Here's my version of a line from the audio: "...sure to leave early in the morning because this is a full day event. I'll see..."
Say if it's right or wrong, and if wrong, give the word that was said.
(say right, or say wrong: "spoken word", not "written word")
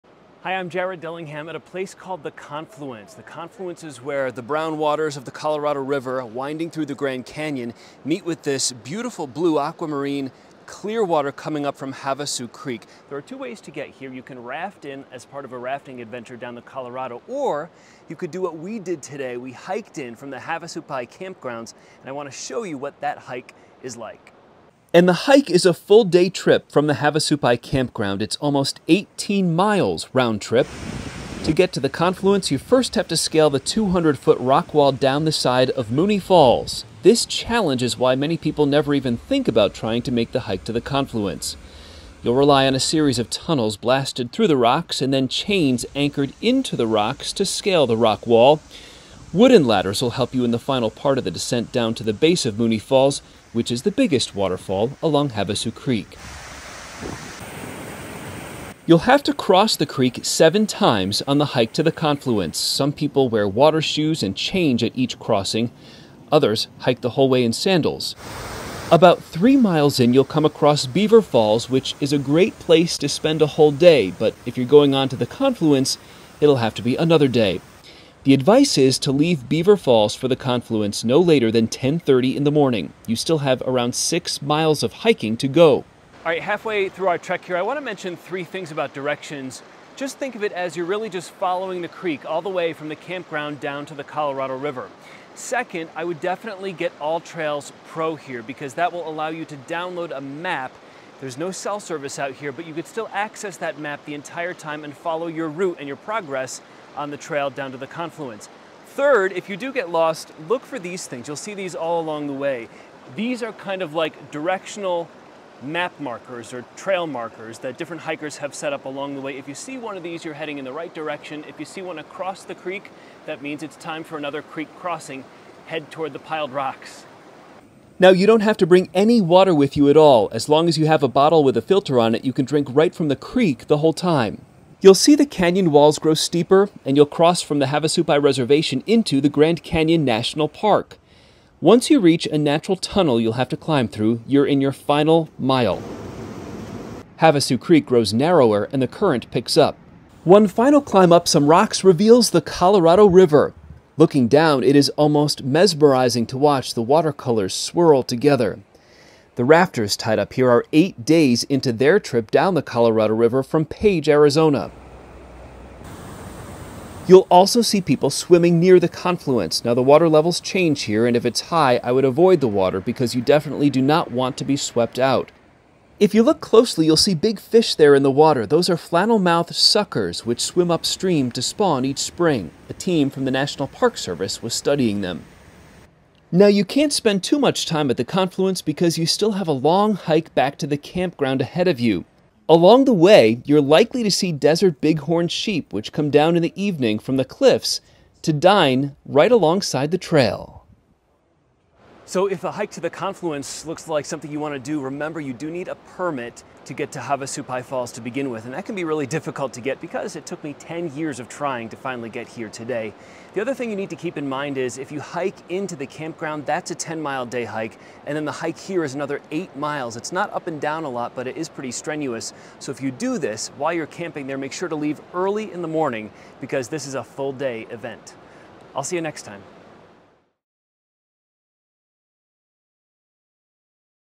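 right.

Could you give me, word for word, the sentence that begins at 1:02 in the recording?
Some people wear water shoes and change at each crossing.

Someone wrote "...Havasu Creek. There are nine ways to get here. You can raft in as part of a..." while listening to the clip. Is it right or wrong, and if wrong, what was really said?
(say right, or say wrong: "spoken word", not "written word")
wrong: "two", not "nine".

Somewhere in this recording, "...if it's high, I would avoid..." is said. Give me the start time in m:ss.
2:51.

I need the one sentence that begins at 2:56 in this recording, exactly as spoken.
If you look closely, you'll see big fish there in the water.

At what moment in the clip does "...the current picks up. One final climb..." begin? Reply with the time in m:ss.
2:28.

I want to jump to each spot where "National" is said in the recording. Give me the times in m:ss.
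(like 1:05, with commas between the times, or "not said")
2:20, 3:03.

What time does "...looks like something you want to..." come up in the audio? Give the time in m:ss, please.
3:23.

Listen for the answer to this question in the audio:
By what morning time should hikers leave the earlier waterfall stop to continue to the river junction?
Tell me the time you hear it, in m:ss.
1:21.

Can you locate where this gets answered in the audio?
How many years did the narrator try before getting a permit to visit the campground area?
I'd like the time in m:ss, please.
3:30.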